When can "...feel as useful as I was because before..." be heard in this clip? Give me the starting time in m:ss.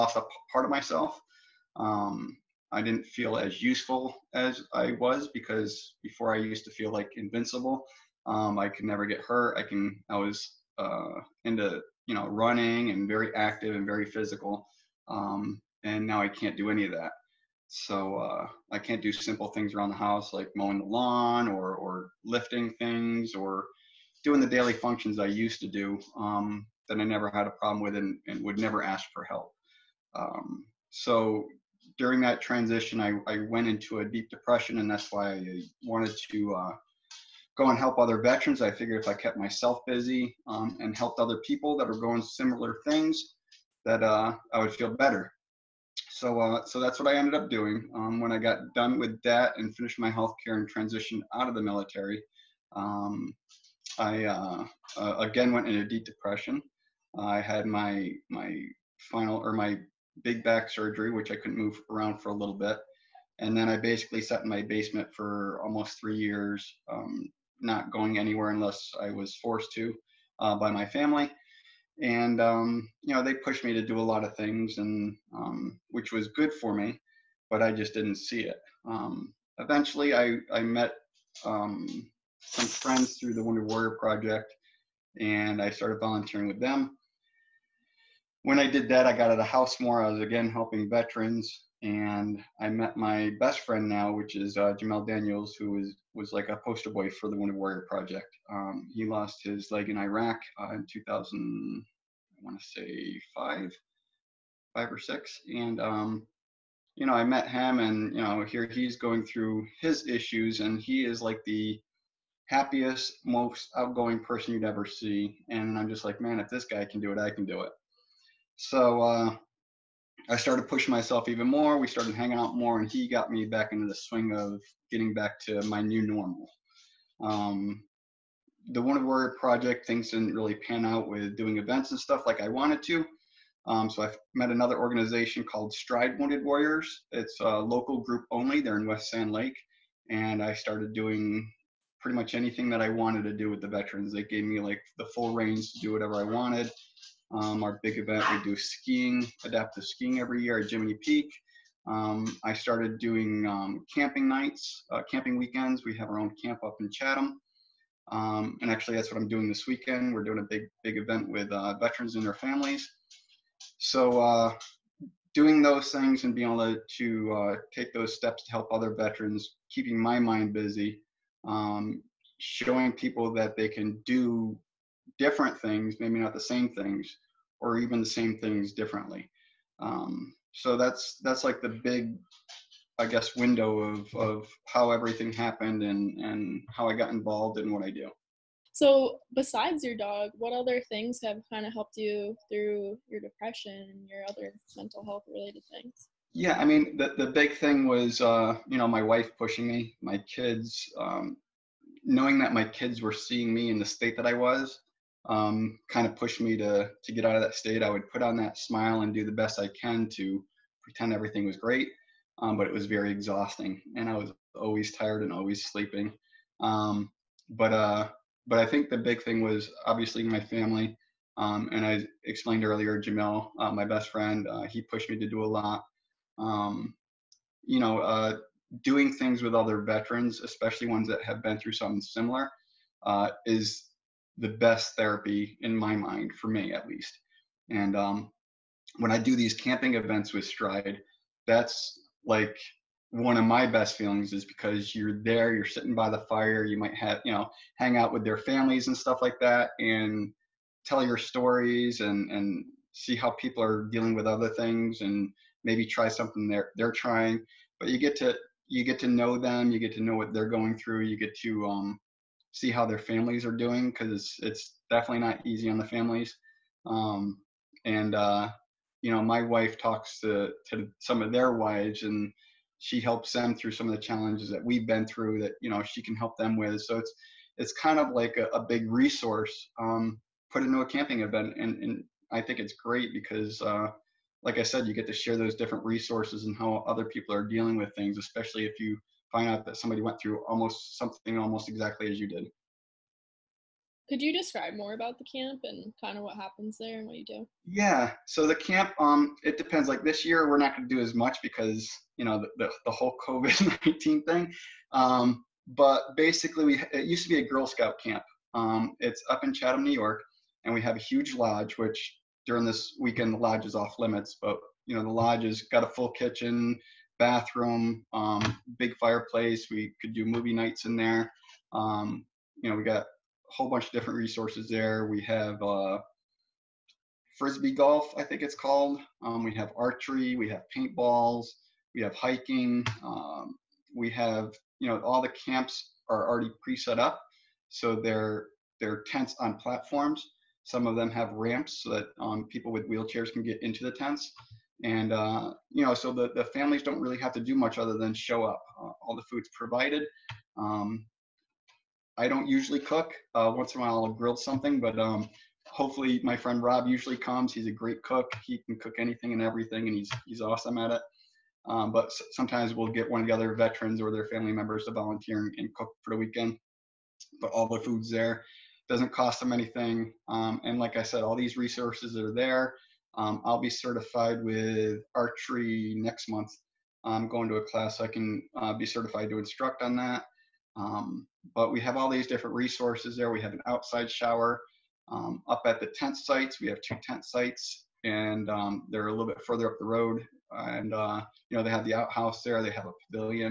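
0:03.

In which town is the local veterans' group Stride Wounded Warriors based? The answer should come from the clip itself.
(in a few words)
West Sand Lake.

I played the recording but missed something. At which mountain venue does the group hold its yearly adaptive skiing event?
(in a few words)
Jiminy Peak.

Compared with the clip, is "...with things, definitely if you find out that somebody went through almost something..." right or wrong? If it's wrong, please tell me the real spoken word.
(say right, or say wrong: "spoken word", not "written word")
wrong: "especially", not "definitely".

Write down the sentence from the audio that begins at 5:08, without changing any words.
Um, it's up in Chatham, New York, and we have a huge lodge.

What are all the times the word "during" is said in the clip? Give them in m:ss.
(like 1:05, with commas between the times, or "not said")
0:31, 5:12.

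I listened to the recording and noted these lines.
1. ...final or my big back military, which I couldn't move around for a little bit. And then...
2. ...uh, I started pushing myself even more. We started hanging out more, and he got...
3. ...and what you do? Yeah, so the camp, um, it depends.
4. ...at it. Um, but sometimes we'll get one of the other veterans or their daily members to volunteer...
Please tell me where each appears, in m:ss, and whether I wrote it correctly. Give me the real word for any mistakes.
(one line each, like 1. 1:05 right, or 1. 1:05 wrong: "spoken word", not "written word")
1. 0:59 wrong: "surgery", not "military"
2. 1:59 right
3. 4:56 right
4. 6:00 wrong: "family", not "daily".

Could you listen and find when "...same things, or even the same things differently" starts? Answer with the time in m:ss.
2:56.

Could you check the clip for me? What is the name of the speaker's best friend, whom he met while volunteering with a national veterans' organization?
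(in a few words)
Jamel Daniels.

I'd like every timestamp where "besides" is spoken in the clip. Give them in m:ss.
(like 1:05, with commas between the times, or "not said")
3:09.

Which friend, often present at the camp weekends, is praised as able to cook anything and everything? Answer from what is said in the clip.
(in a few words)
Rob.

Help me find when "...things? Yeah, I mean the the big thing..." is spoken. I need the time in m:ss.
3:15.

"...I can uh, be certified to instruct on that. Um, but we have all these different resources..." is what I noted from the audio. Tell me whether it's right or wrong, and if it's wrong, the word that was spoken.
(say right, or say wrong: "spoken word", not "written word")
right.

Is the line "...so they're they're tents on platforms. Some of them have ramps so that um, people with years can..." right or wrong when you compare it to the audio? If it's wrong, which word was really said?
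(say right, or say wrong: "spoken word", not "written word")
wrong: "wheelchairs", not "years".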